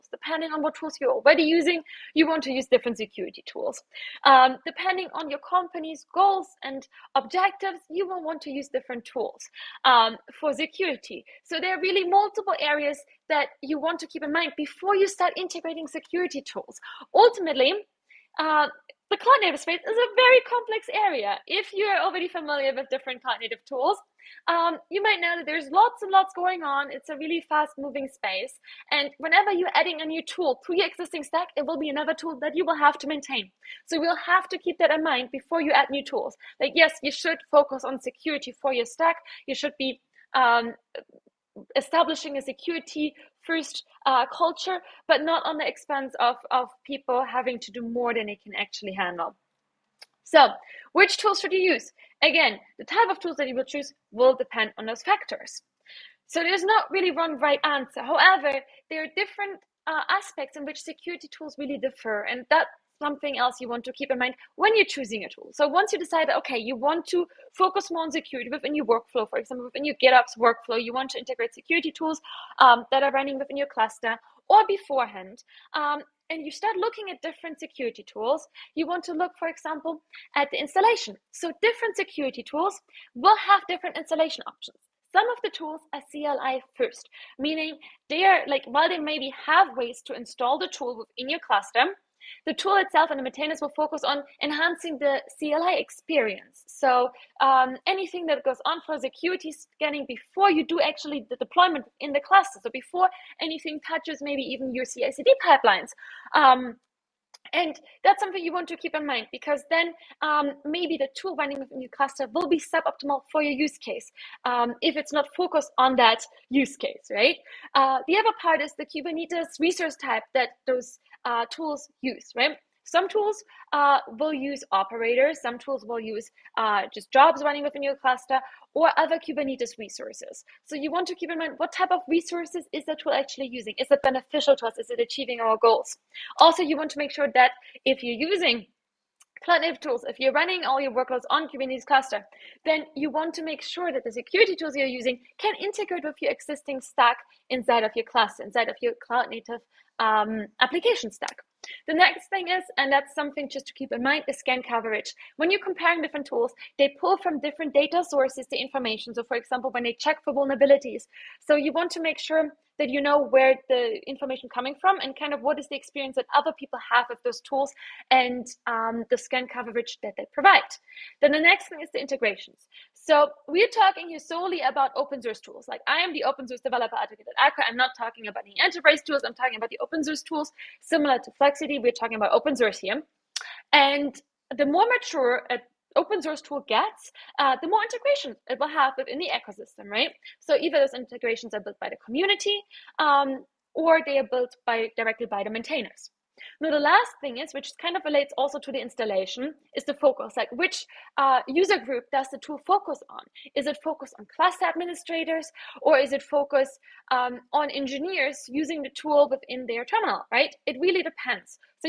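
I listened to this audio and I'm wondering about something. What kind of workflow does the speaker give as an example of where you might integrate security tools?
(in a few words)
GitOps workflow.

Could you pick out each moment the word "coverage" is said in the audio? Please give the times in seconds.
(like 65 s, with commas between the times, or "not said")
154 s, 169 s.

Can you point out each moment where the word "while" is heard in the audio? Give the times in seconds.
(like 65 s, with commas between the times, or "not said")
88 s.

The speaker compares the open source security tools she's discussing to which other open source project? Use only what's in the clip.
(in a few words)
Flux CD.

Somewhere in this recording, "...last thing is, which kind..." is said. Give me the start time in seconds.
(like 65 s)
196 s.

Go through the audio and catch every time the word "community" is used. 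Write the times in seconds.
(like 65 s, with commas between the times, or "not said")
192 s.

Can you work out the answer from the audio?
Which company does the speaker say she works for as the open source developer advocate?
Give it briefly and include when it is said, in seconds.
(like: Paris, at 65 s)
Aqua, at 177 s.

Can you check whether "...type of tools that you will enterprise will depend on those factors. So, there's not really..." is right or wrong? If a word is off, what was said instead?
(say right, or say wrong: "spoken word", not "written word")
wrong: "choose", not "enterprise".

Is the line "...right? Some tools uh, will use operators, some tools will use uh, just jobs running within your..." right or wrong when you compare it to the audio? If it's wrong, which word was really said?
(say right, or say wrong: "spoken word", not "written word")
right.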